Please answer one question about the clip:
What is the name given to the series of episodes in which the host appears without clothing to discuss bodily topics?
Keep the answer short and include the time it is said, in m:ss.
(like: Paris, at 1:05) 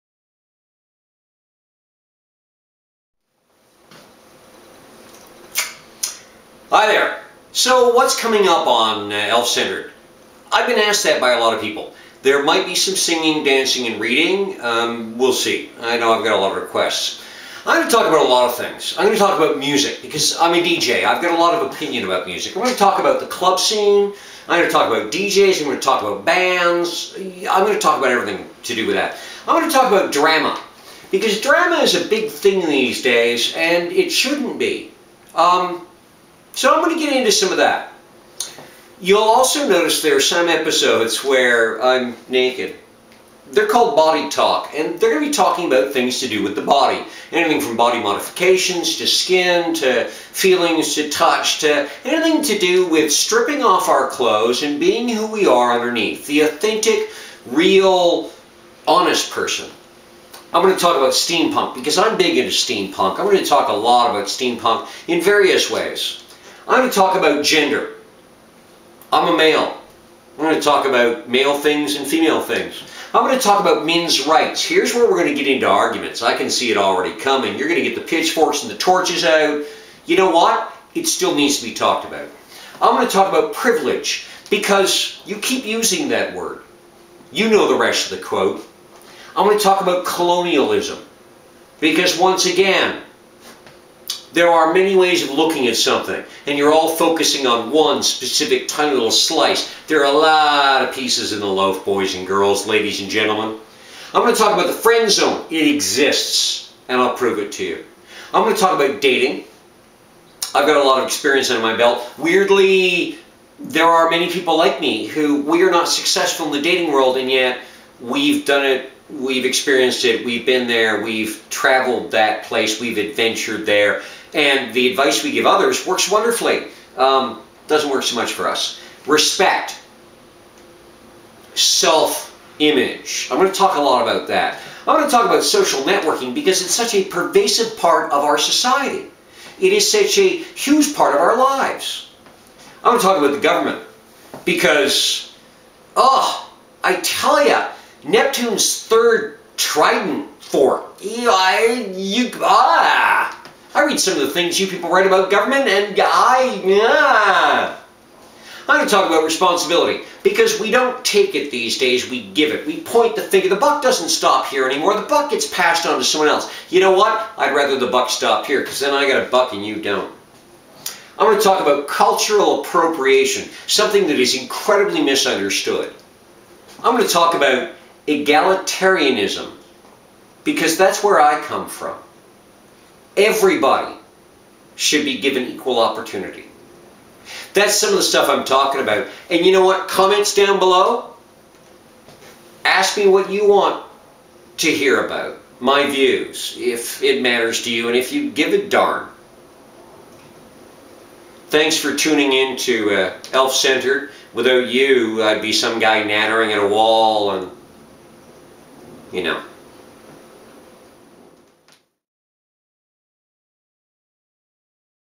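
Body Talk, at 0:43.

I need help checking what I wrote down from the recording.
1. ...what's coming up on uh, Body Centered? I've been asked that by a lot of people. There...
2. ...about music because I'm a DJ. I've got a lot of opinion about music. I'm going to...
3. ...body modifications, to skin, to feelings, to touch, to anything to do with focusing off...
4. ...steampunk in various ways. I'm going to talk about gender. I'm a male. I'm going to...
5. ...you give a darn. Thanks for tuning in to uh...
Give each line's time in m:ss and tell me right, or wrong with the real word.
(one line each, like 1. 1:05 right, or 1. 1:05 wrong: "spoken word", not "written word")
1. 0:07 wrong: "Elf", not "Body"
2. 0:19 right
3. 0:47 wrong: "stripping", not "focusing"
4. 1:04 right
5. 3:18 right.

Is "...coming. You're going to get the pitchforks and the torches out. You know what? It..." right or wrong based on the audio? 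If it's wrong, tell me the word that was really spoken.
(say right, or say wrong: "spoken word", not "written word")
right.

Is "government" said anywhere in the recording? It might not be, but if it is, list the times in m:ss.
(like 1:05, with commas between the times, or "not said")
2:23, 2:35.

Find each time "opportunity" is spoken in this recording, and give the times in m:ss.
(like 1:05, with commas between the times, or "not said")
3:05.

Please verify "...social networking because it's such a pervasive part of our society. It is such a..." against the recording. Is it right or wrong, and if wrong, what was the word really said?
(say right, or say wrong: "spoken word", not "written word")
right.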